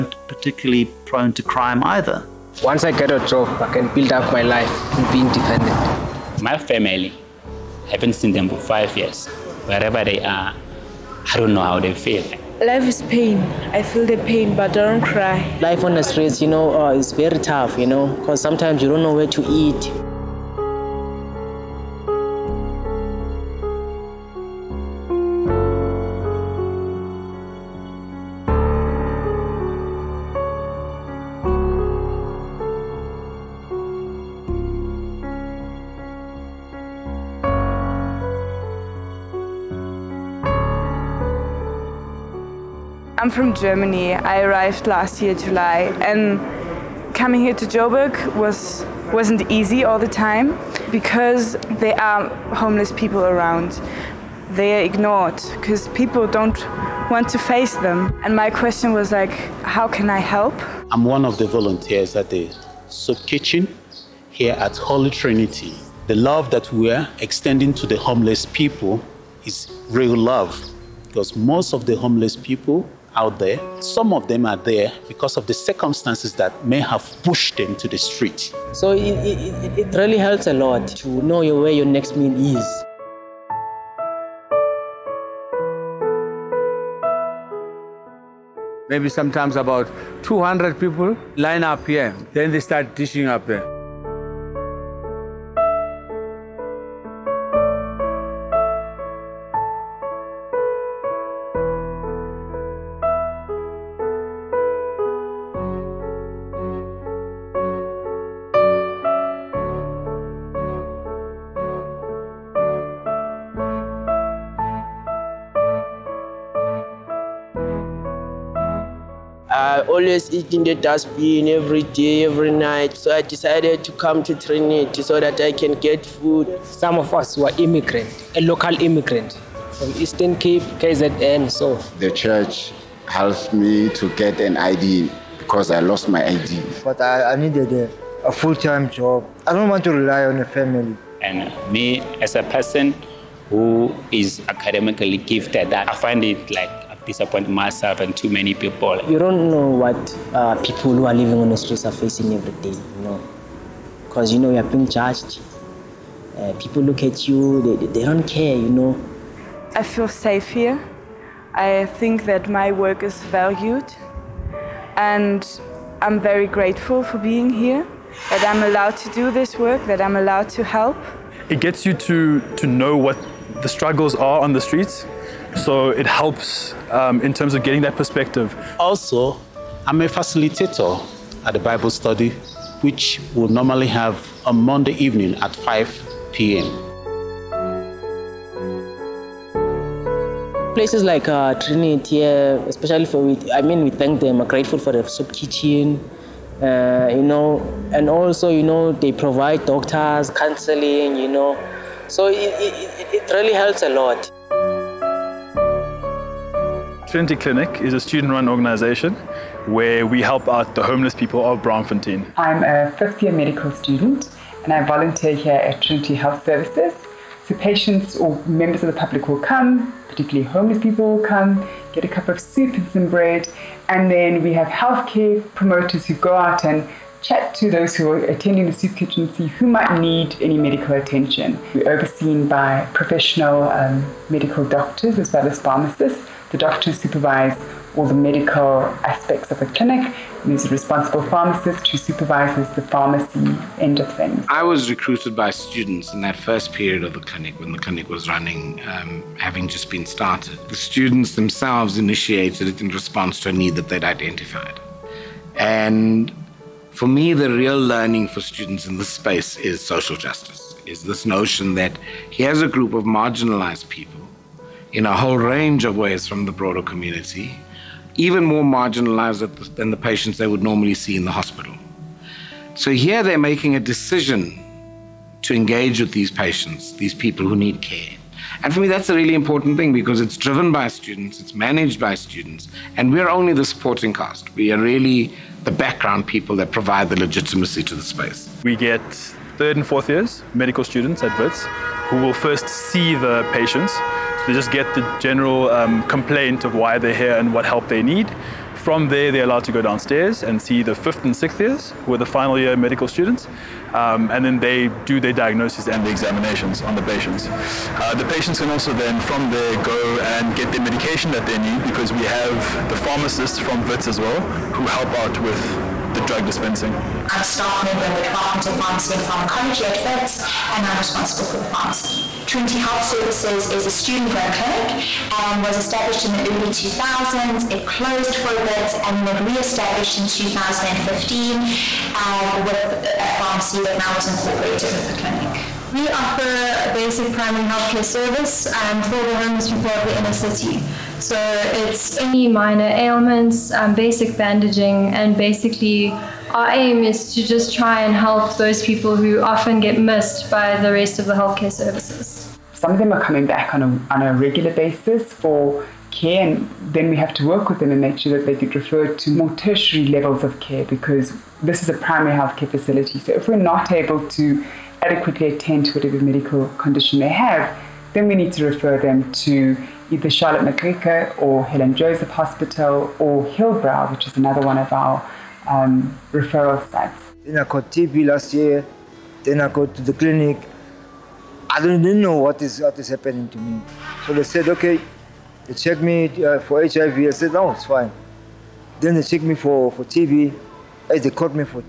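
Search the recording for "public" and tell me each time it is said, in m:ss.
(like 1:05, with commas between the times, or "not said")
3:38.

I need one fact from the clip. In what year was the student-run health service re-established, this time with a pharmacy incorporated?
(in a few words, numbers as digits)
2015.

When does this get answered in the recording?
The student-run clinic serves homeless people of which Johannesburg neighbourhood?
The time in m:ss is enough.
3:31.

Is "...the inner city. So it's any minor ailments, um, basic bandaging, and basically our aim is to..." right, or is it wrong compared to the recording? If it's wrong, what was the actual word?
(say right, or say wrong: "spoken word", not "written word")
right.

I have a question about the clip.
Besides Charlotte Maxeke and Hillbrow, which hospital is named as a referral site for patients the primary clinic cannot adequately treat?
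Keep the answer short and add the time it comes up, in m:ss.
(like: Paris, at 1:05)
Helen Joseph Hospital, at 6:11.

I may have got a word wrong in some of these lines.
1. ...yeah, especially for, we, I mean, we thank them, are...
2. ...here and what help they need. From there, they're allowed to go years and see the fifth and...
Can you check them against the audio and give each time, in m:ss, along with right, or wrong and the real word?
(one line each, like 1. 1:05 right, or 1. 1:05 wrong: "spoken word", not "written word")
1. 3:12 right
2. 4:57 wrong: "downstairs", not "years".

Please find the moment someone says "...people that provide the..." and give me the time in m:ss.
4:46.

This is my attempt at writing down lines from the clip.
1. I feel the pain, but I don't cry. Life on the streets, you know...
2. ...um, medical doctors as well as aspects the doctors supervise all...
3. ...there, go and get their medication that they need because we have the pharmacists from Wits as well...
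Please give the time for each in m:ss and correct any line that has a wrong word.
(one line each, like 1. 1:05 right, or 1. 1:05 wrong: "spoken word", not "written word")
1. 0:13 right
2. 3:53 wrong: "pharmacists", not "aspects"
3. 5:09 right.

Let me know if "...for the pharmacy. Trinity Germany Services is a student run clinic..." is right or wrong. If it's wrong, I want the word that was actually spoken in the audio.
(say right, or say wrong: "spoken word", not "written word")
wrong: "Health", not "Germany".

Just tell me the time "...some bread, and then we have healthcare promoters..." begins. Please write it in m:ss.
3:42.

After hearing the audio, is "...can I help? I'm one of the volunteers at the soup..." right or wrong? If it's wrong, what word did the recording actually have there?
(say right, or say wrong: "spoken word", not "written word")
right.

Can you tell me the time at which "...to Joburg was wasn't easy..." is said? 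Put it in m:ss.
0:47.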